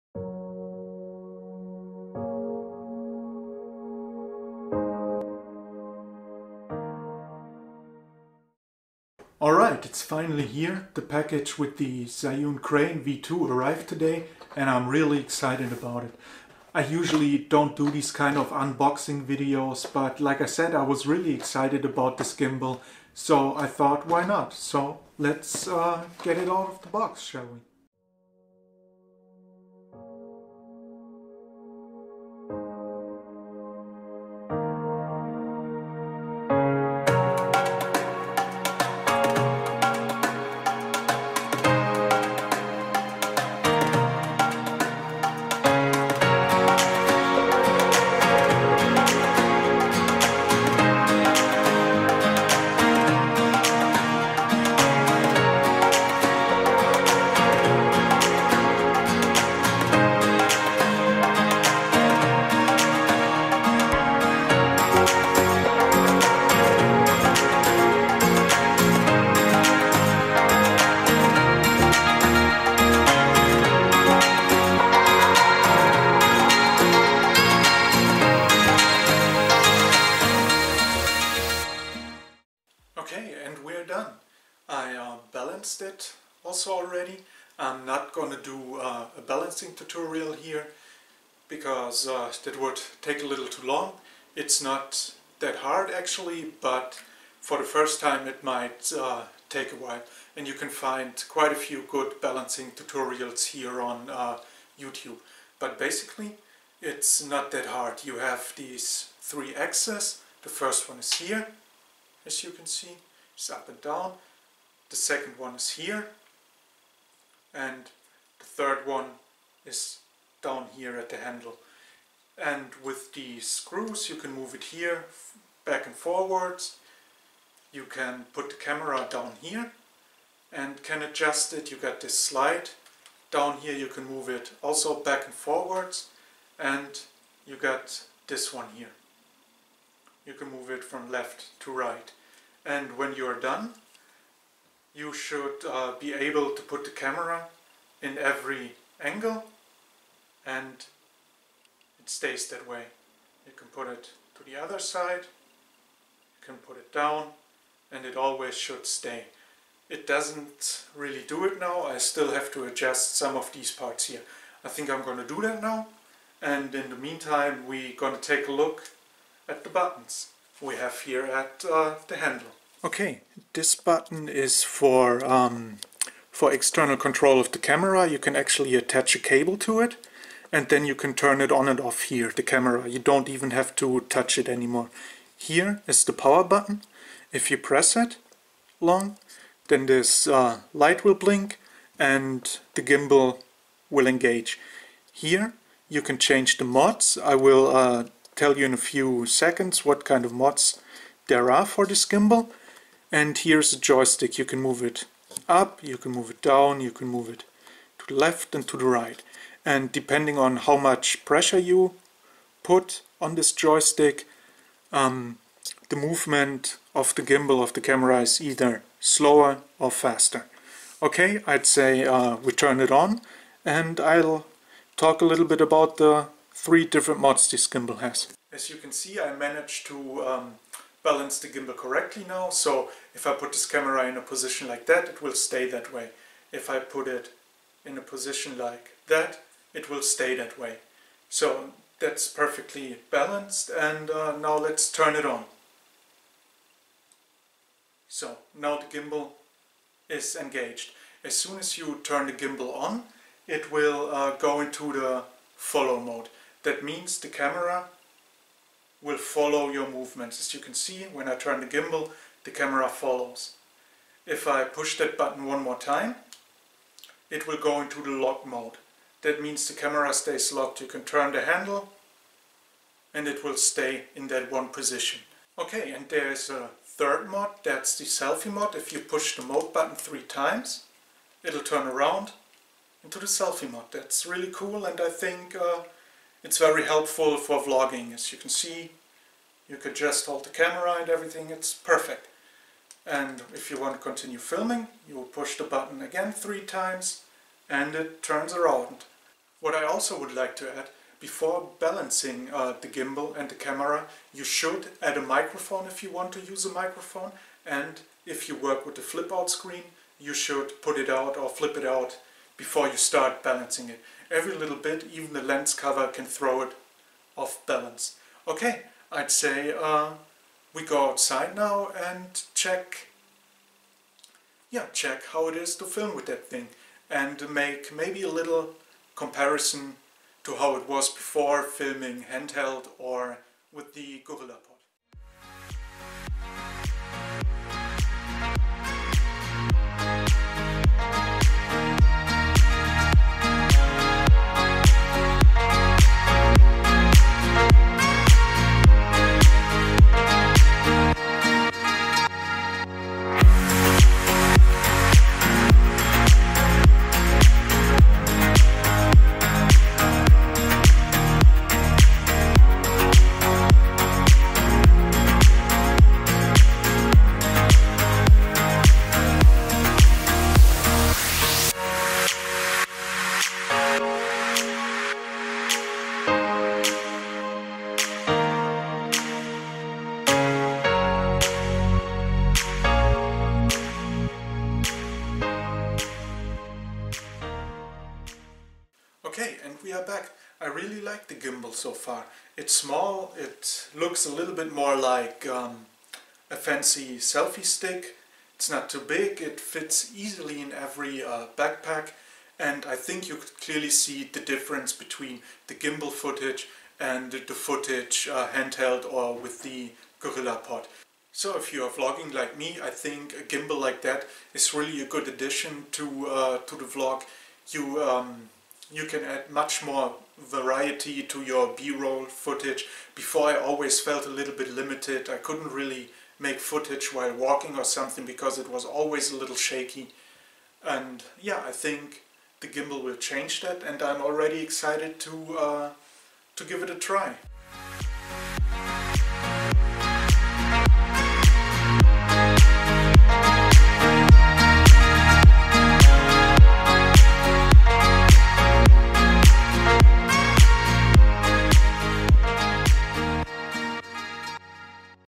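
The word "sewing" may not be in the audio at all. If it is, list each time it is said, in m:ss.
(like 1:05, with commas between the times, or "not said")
not said.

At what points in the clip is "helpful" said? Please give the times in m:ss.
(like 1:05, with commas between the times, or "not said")
4:46.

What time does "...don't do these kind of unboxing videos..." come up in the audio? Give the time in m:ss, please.
0:17.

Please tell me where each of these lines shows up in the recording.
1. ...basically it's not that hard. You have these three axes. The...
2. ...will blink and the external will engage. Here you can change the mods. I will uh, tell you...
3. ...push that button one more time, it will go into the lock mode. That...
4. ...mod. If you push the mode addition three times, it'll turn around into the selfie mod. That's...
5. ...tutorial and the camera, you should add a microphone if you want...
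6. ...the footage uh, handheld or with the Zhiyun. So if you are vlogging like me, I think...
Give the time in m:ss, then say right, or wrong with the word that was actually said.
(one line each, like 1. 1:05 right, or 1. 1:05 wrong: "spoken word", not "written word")
1. 1:45 right
2. 3:11 wrong: "gimbal", not "external"
3. 4:24 right
4. 4:38 wrong: "button", not "addition"
5. 5:02 wrong: "gimbal", not "tutorial"
6. 6:47 wrong: "GorillaPod", not "Zhiyun".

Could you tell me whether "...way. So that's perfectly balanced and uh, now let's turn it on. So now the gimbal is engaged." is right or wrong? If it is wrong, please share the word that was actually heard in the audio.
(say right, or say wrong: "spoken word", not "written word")
right.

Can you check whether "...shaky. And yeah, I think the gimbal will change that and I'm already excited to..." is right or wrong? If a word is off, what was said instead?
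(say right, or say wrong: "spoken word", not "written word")
right.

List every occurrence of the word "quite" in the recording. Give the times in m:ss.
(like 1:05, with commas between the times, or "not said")
1:41.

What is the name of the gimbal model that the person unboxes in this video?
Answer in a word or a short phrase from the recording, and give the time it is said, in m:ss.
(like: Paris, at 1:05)
Zhiyun Crane V2, at 0:12.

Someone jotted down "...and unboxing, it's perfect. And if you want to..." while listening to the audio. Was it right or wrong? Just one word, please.
wrong.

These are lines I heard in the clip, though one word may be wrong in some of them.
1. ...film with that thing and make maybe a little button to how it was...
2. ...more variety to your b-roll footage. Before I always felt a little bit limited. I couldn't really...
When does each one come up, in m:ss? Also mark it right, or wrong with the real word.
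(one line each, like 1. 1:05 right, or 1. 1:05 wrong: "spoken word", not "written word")
1. 5:25 wrong: "comparison", not "button"
2. 6:59 right.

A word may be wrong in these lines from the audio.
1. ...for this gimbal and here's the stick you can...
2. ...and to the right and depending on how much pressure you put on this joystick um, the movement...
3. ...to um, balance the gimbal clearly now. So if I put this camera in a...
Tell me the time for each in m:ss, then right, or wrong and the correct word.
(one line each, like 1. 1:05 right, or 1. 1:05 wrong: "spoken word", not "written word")
1. 3:21 wrong: "joystick", not "stick"
2. 3:28 right
3. 3:49 wrong: "correctly", not "clearly".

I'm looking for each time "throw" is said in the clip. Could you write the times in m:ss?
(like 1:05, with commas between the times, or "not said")
5:16.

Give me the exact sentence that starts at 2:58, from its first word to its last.
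You can actually attach a cable to it and then you can turn it on and off here, the camera.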